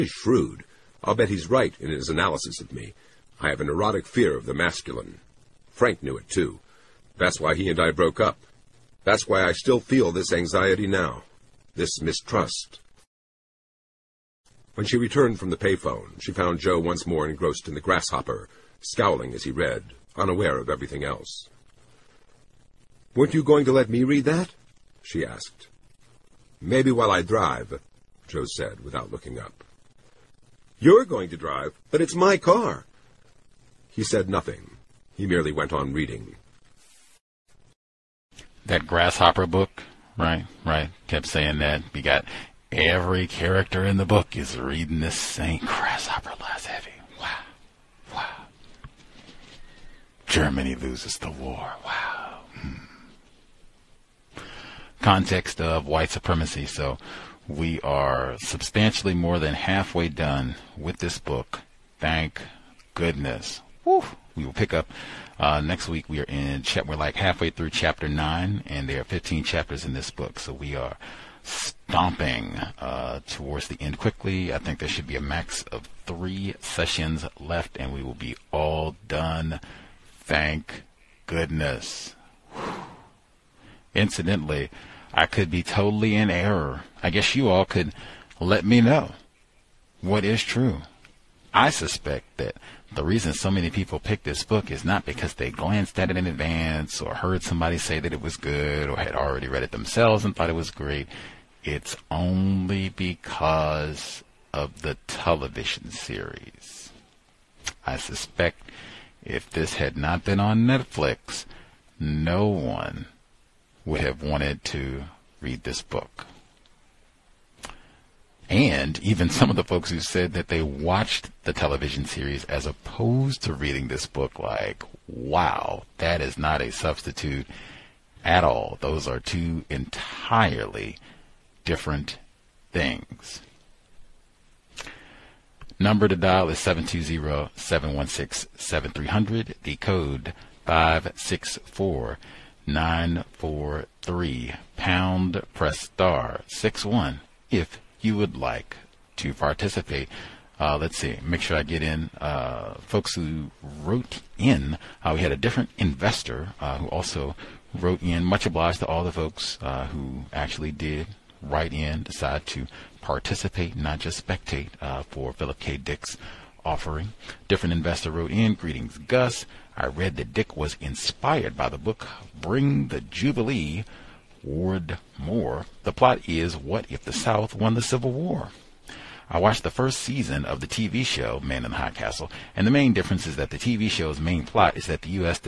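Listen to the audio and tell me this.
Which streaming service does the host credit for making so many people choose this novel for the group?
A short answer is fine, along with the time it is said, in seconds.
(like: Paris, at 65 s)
Netflix, at 110 s.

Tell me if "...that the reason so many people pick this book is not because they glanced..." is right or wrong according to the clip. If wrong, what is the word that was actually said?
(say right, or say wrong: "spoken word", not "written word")
right.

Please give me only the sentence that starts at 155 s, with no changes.
Uh, we had a different investor uh, who also wrote in.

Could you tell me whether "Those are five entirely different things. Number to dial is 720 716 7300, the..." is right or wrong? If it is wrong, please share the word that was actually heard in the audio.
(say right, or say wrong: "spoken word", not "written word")
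wrong: "two", not "five".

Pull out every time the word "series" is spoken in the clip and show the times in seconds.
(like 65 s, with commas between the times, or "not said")
105 s, 122 s.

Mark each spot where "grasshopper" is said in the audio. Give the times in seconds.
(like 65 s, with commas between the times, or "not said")
17 s, 38 s, 45 s.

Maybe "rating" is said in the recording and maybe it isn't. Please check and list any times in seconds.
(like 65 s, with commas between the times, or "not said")
not said.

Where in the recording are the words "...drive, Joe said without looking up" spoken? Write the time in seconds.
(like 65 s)
27 s.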